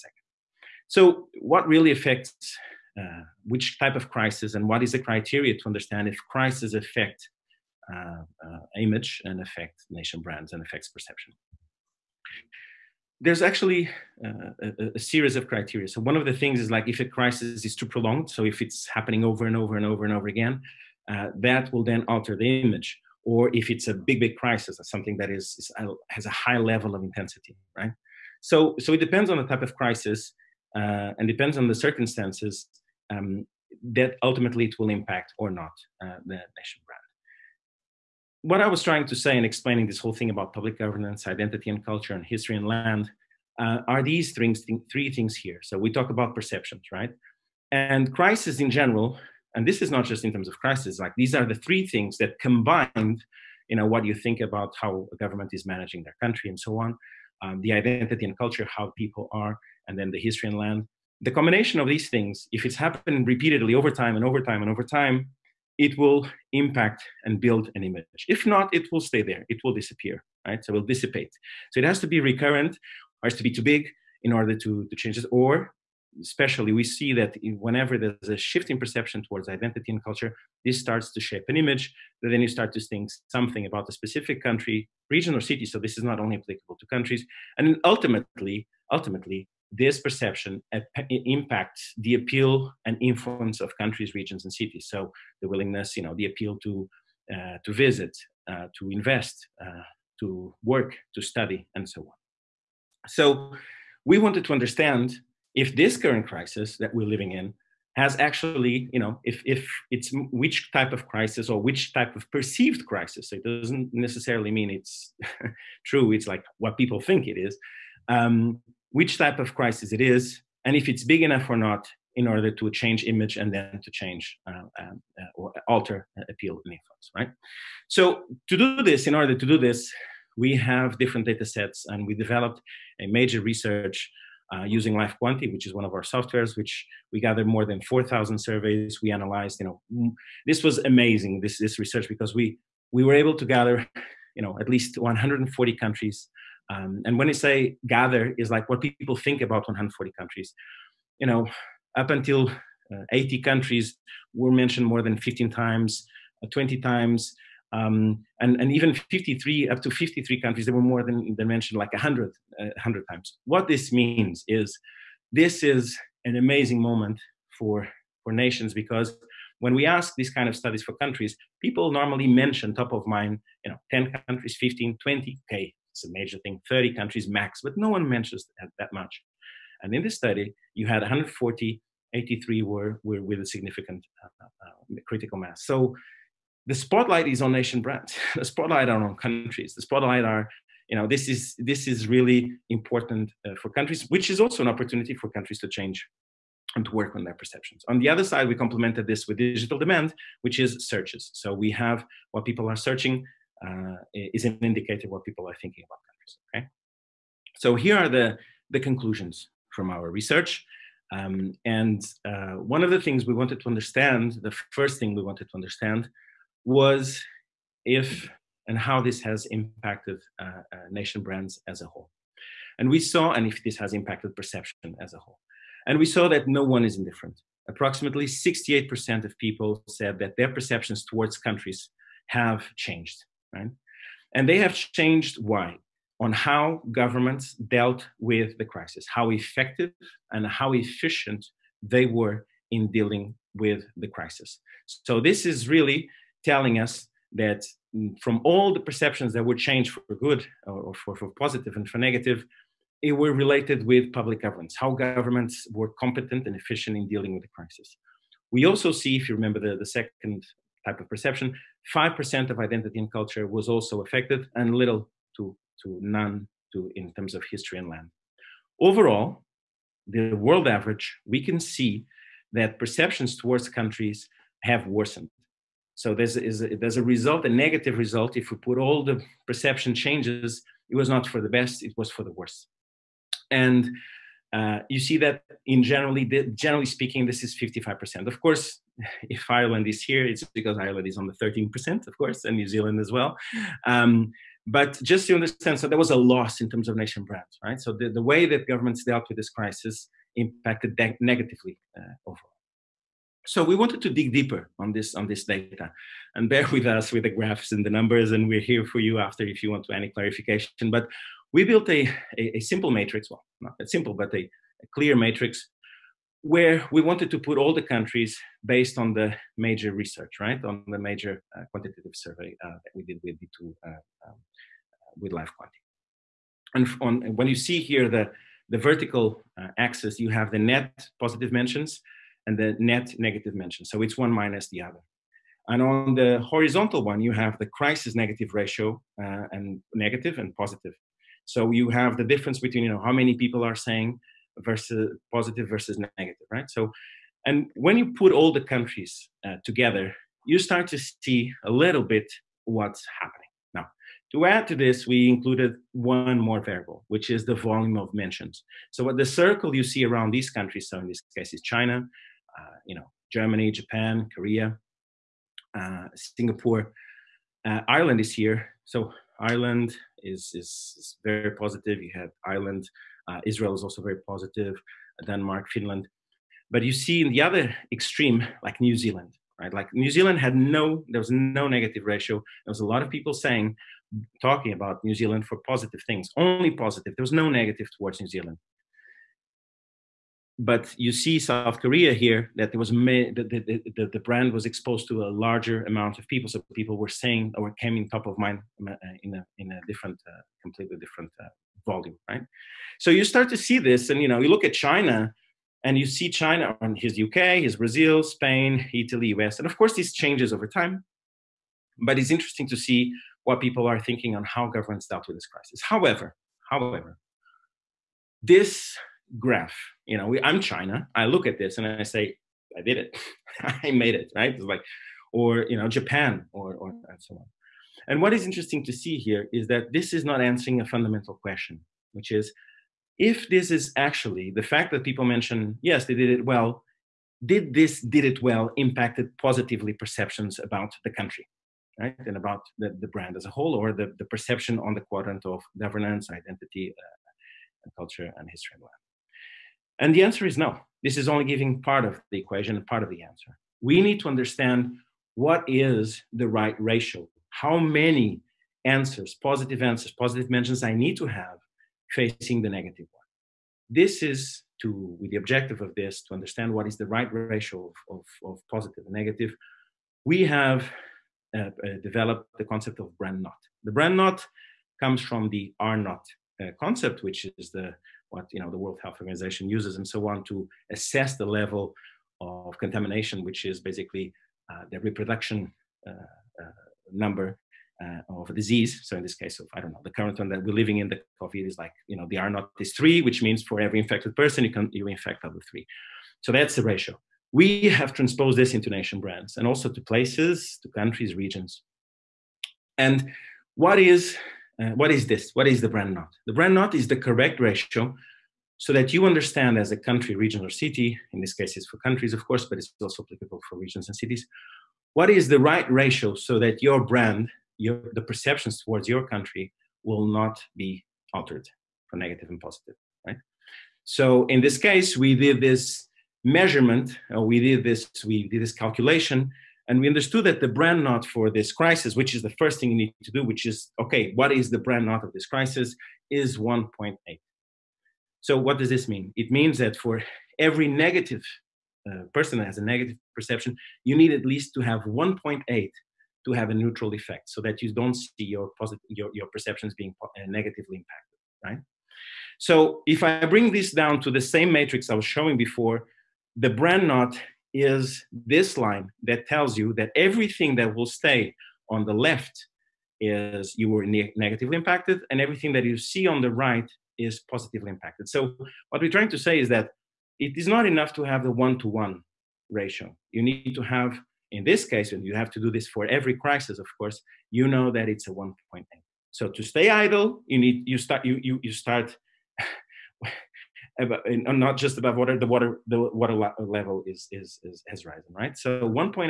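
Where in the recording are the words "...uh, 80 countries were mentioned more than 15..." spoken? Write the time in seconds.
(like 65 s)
152 s.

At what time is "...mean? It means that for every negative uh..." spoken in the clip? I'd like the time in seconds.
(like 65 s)
539 s.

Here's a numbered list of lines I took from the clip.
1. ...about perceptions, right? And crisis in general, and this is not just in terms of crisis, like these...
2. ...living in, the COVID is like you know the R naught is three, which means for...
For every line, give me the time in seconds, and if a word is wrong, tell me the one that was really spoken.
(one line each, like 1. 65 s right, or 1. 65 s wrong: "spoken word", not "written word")
1. 46 s right
2. 490 s right.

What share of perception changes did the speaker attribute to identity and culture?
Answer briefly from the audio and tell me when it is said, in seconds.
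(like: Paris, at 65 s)
5%, at 261 s.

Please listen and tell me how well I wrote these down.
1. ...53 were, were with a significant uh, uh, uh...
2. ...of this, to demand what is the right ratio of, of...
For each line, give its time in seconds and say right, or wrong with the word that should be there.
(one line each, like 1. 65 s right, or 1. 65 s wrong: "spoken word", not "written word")
1. 182 s wrong: "83", not "53"
2. 465 s wrong: "understand", not "demand".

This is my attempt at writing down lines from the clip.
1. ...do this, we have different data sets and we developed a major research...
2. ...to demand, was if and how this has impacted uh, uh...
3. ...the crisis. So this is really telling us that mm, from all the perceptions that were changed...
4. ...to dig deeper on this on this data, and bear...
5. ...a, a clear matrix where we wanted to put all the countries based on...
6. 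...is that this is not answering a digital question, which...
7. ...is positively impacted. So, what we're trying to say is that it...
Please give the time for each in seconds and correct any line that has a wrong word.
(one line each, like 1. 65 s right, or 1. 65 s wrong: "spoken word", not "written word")
1. 129 s right
2. 215 s wrong: "understand", not "demand"
3. 243 s right
4. 304 s right
5. 314 s right
6. 429 s wrong: "fundamental", not "digital"
7. 567 s right.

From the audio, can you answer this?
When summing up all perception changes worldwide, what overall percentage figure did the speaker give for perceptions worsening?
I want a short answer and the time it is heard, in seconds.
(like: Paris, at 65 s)
55%, at 287 s.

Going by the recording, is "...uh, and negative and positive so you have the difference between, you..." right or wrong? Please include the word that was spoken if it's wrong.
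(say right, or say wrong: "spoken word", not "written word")
right.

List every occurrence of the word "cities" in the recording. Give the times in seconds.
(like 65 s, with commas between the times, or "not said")
94 s, 514 s.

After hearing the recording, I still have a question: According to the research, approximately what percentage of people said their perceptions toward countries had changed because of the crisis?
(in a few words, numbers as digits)
68%.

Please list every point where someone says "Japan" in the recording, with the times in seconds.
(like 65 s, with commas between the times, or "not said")
363 s, 425 s.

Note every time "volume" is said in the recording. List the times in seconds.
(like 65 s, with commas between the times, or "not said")
357 s, 401 s.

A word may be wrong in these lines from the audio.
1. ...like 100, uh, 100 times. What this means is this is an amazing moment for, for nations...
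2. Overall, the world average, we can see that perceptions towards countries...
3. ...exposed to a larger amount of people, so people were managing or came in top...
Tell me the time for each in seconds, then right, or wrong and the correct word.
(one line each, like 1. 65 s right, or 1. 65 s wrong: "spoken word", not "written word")
1. 161 s right
2. 268 s right
3. 394 s wrong: "saying", not "managing".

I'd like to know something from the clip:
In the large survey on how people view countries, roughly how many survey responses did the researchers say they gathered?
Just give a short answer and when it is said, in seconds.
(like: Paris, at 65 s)
more than 4,000, at 137 s.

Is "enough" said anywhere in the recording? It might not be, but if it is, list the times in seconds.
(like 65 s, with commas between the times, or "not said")
121 s, 570 s.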